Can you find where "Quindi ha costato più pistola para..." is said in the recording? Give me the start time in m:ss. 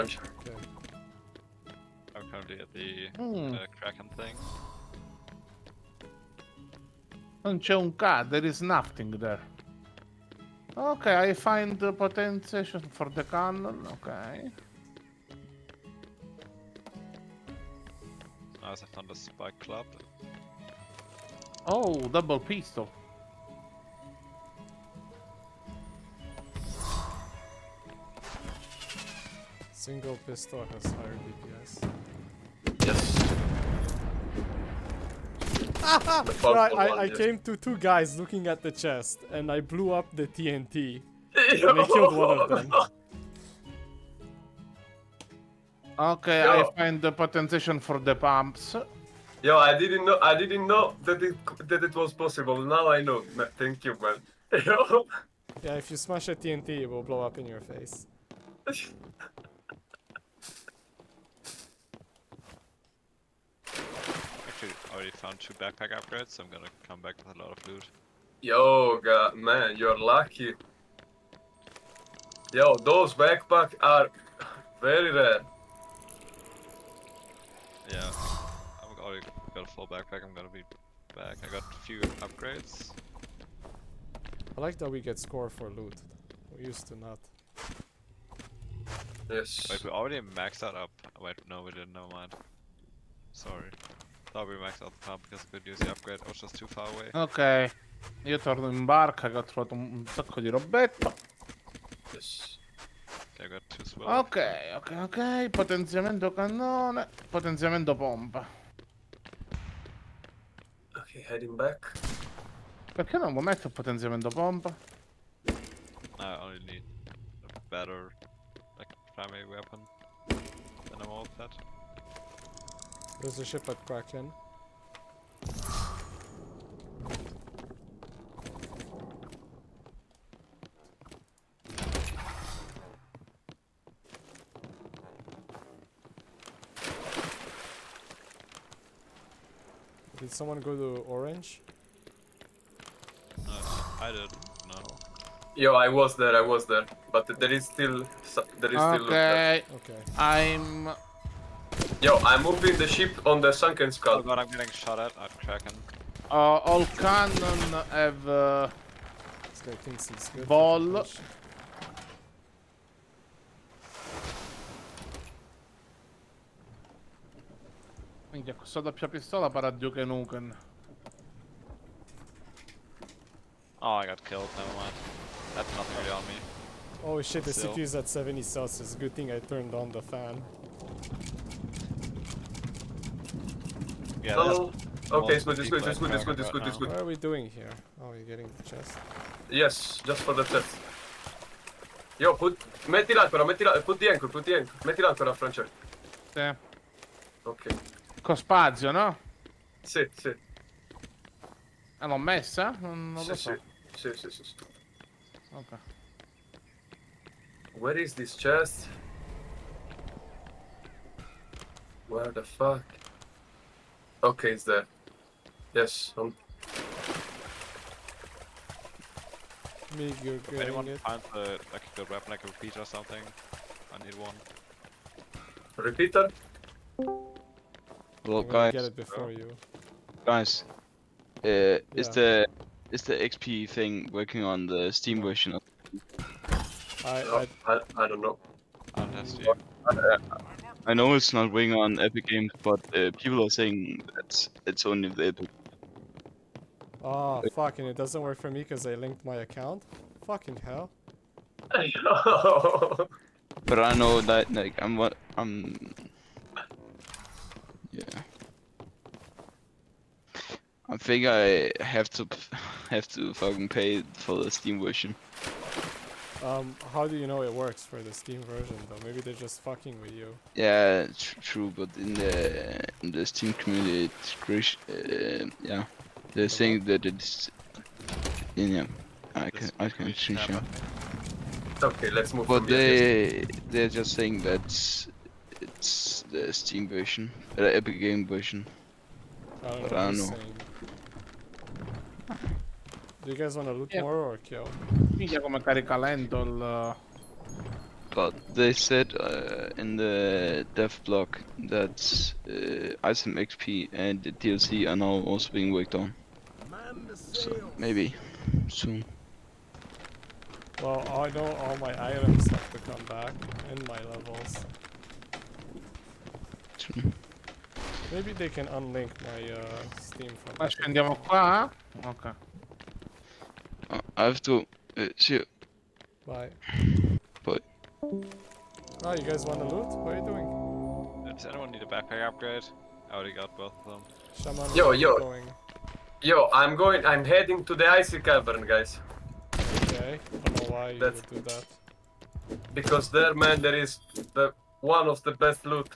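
2:48.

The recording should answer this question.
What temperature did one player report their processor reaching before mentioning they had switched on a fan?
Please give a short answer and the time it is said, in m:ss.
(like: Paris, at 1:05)
70 celsius, at 2:58.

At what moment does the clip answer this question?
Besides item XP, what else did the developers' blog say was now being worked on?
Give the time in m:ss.
5:04.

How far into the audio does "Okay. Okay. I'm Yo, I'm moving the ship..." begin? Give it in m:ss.
2:29.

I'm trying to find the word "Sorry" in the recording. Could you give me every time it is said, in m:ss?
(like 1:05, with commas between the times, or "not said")
1:33.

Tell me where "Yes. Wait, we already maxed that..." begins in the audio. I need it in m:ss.
1:29.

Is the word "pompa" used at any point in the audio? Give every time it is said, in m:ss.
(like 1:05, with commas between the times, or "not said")
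1:47, 1:54.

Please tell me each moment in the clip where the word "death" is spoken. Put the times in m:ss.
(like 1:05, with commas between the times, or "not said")
not said.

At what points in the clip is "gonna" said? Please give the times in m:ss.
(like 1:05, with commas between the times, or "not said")
1:06, 1:20.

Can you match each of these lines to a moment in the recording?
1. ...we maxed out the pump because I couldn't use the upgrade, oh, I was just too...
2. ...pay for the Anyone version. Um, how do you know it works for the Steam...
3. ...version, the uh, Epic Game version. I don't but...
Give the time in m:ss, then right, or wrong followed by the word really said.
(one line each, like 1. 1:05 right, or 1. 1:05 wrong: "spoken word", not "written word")
1. 1:34 right
2. 4:23 wrong: "Steam", not "Anyone"
3. 4:46 right.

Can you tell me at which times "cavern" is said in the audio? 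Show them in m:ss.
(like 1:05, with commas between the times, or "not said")
5:38.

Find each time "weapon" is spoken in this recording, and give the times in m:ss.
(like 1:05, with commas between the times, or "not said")
1:59, 3:42.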